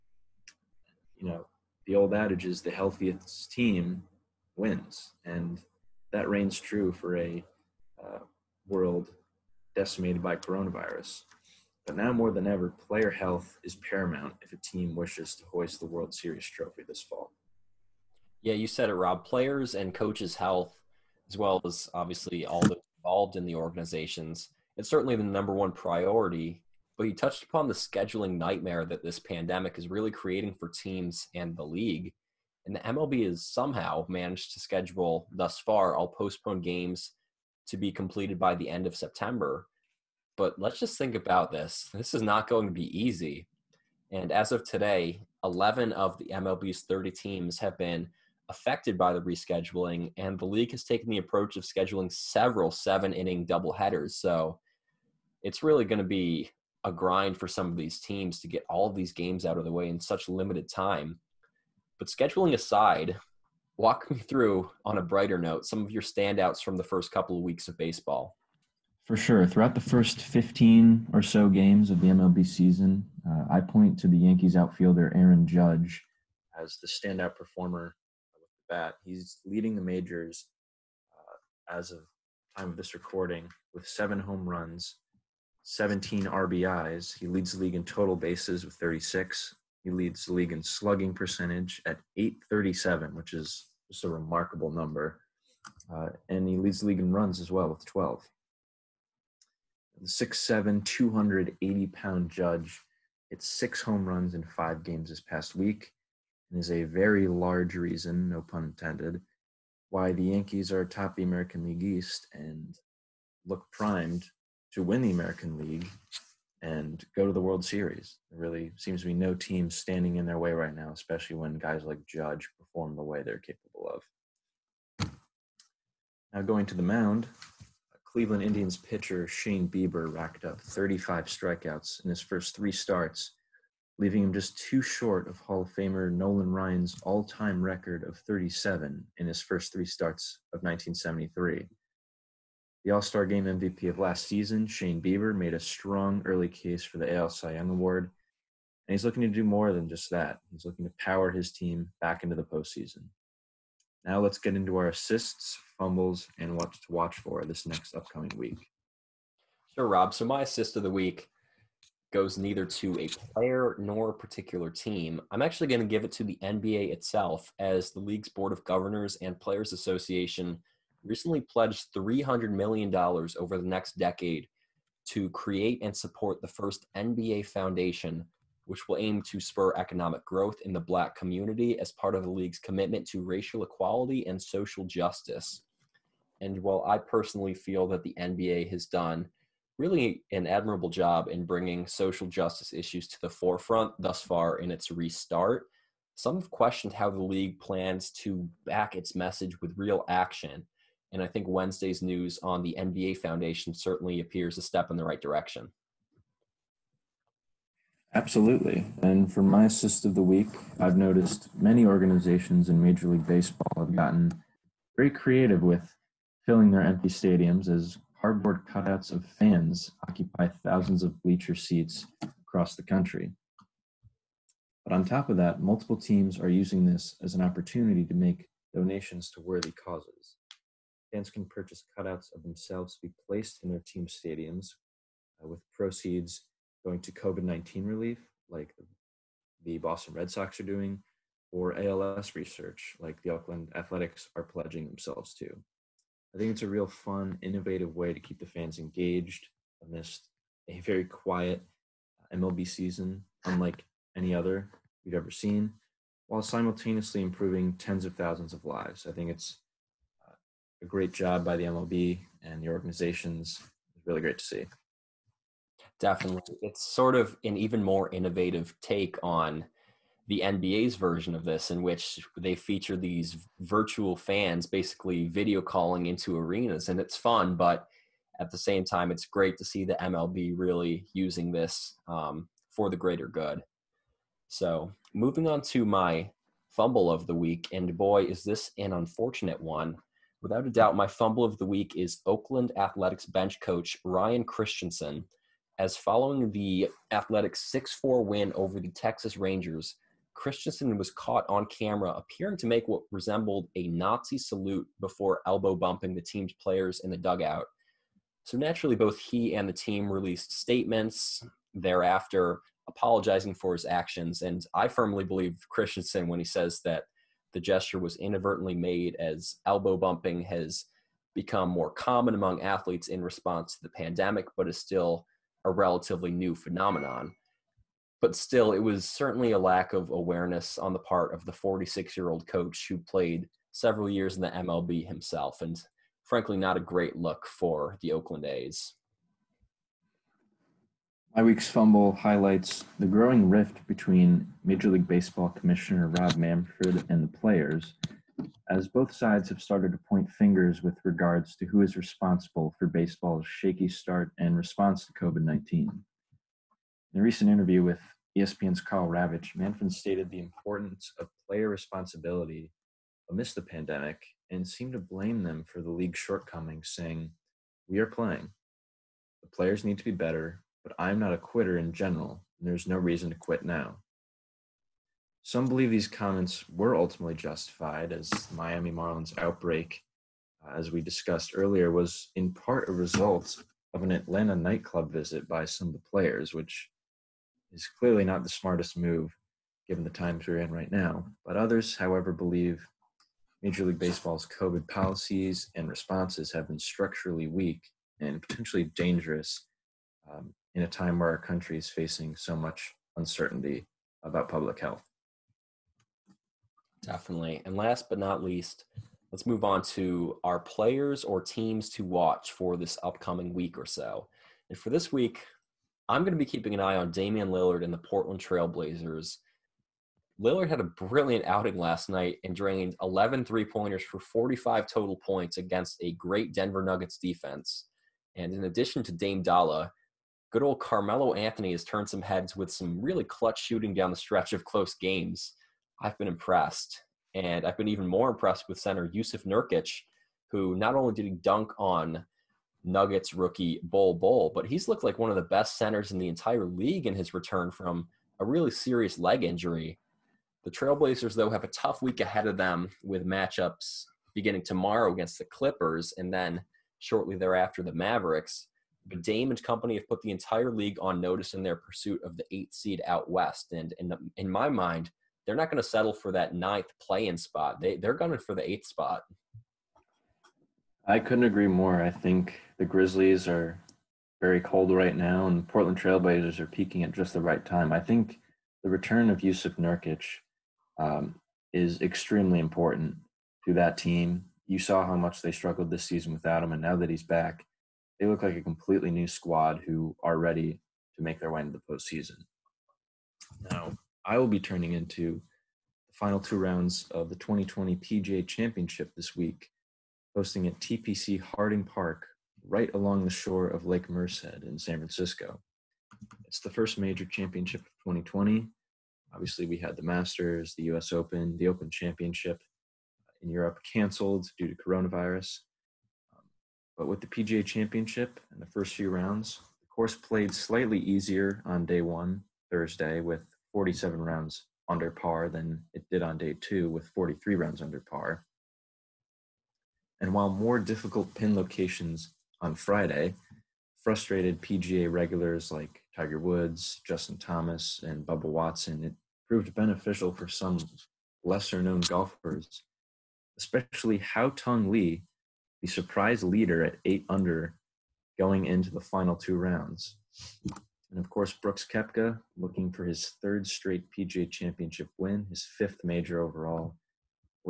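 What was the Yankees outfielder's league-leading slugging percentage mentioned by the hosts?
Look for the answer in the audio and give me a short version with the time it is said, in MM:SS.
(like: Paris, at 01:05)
.837, at 01:32.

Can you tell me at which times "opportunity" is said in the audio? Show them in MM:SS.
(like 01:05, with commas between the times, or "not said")
03:47.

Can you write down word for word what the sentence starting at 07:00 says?
Lillard had a brilliant outing last night and drained 11 three pointers for 45 total points against a great Denver Nuggets defense.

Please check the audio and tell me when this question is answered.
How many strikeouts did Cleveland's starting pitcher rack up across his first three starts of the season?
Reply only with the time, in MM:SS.
02:10.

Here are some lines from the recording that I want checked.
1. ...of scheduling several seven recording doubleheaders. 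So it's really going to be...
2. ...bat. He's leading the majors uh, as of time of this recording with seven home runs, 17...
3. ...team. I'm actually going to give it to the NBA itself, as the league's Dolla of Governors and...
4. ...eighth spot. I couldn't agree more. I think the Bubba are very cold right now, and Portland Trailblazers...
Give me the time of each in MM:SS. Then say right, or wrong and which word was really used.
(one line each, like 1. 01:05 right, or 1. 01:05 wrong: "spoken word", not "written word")
1. 00:51 wrong: "inning", not "recording"
2. 01:18 right
3. 02:44 wrong: "Board", not "Dolla"
4. 07:48 wrong: "Grizzlies", not "Bubba".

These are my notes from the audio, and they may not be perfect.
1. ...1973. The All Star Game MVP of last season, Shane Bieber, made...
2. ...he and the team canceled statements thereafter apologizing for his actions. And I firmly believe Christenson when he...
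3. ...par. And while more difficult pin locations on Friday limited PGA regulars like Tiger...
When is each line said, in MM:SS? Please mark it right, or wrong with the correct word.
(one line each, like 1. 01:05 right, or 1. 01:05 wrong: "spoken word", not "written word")
1. 02:20 right
2. 05:09 wrong: "released", not "canceled"
3. 08:48 wrong: "frustrated", not "limited".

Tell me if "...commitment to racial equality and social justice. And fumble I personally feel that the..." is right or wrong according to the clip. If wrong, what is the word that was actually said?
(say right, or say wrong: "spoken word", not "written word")
wrong: "while", not "fumble".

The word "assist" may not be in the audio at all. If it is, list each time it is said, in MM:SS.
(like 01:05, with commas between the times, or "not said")
02:34, 02:40, 03:29.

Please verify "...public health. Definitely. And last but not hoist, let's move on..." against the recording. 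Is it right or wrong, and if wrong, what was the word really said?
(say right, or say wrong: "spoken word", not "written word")
wrong: "least", not "hoist".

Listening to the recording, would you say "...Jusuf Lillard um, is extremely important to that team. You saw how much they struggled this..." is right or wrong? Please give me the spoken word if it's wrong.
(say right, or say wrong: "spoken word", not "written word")
wrong: "Nurkic", not "Lillard".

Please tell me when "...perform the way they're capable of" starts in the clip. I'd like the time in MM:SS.
02:02.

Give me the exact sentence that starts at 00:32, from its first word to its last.
And the MLB has somehow managed to schedule thus far all postponed games to be completed by the end of September.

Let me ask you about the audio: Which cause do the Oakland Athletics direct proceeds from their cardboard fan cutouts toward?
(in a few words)
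ALS research.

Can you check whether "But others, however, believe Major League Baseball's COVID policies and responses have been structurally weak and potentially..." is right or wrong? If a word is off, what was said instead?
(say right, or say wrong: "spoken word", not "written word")
right.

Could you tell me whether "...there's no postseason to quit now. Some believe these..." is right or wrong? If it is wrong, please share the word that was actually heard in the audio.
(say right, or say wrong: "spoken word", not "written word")
wrong: "reason", not "postseason".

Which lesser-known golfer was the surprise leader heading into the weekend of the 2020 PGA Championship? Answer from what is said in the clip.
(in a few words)
Haotong Li.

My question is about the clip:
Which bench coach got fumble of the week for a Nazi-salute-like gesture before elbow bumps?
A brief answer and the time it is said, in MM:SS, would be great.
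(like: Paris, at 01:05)
Ryan Christenson, at 04:54.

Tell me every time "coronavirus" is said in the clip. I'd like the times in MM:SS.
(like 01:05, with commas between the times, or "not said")
00:10, 08:34.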